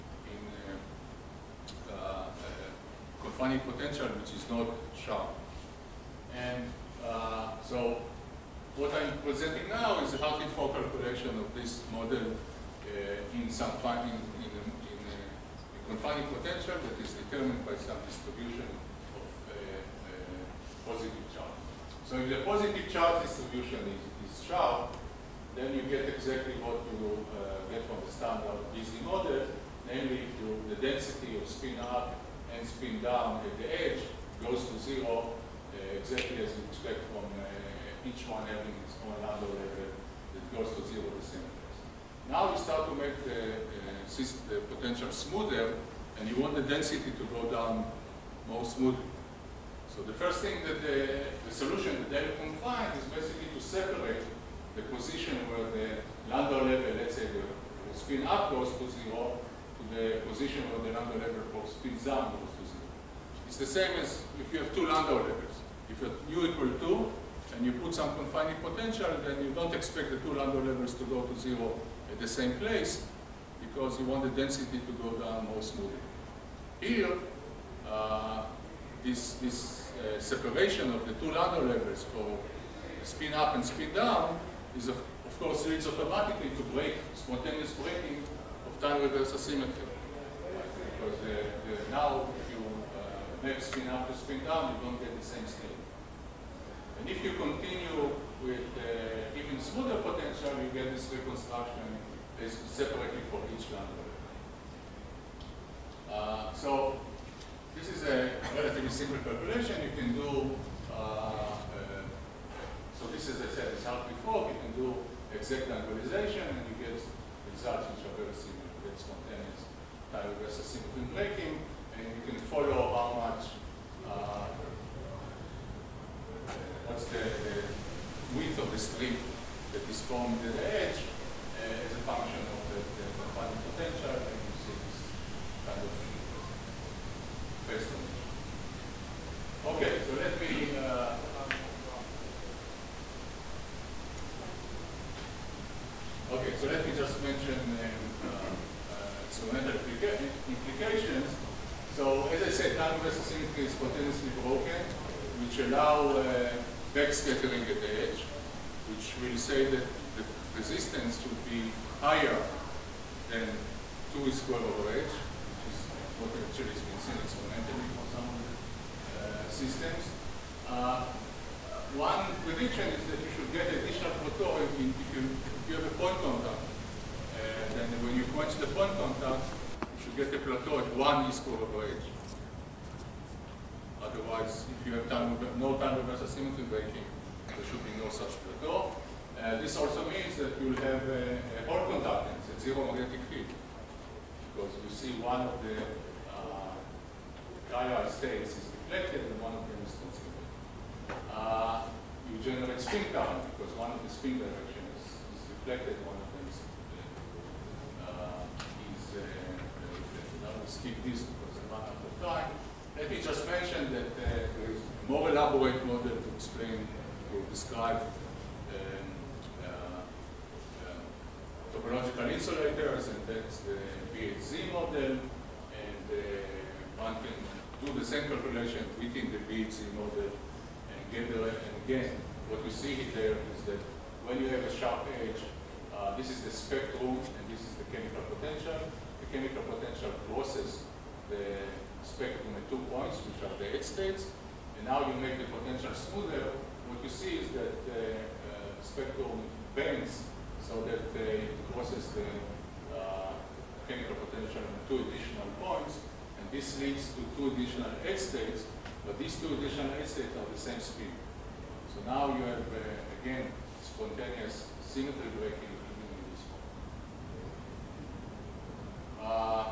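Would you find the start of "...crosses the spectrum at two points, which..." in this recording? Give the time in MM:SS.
04:00.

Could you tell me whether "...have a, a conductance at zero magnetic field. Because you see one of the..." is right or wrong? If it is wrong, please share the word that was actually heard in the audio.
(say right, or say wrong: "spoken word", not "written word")
right.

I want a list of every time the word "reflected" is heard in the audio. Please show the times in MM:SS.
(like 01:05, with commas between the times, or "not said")
03:18, 03:25.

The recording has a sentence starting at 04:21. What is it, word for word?
So now you have, uh, again, spontaneous symmetry breaking in this one.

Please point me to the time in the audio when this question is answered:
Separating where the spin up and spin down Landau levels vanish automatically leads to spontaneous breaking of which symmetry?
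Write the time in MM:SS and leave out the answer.
01:28.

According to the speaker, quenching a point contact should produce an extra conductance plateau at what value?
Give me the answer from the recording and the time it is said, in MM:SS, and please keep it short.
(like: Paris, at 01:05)
1 e²/h, at 03:00.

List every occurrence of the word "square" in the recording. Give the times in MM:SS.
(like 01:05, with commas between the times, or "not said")
02:44, 03:01.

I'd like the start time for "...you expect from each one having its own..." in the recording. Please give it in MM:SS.
00:36.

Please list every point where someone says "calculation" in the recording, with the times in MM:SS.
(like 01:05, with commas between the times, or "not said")
01:49, 03:48.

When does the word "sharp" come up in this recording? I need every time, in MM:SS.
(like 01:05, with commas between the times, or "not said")
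00:04, 00:24, 03:54.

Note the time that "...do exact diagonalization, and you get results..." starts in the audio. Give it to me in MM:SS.
01:54.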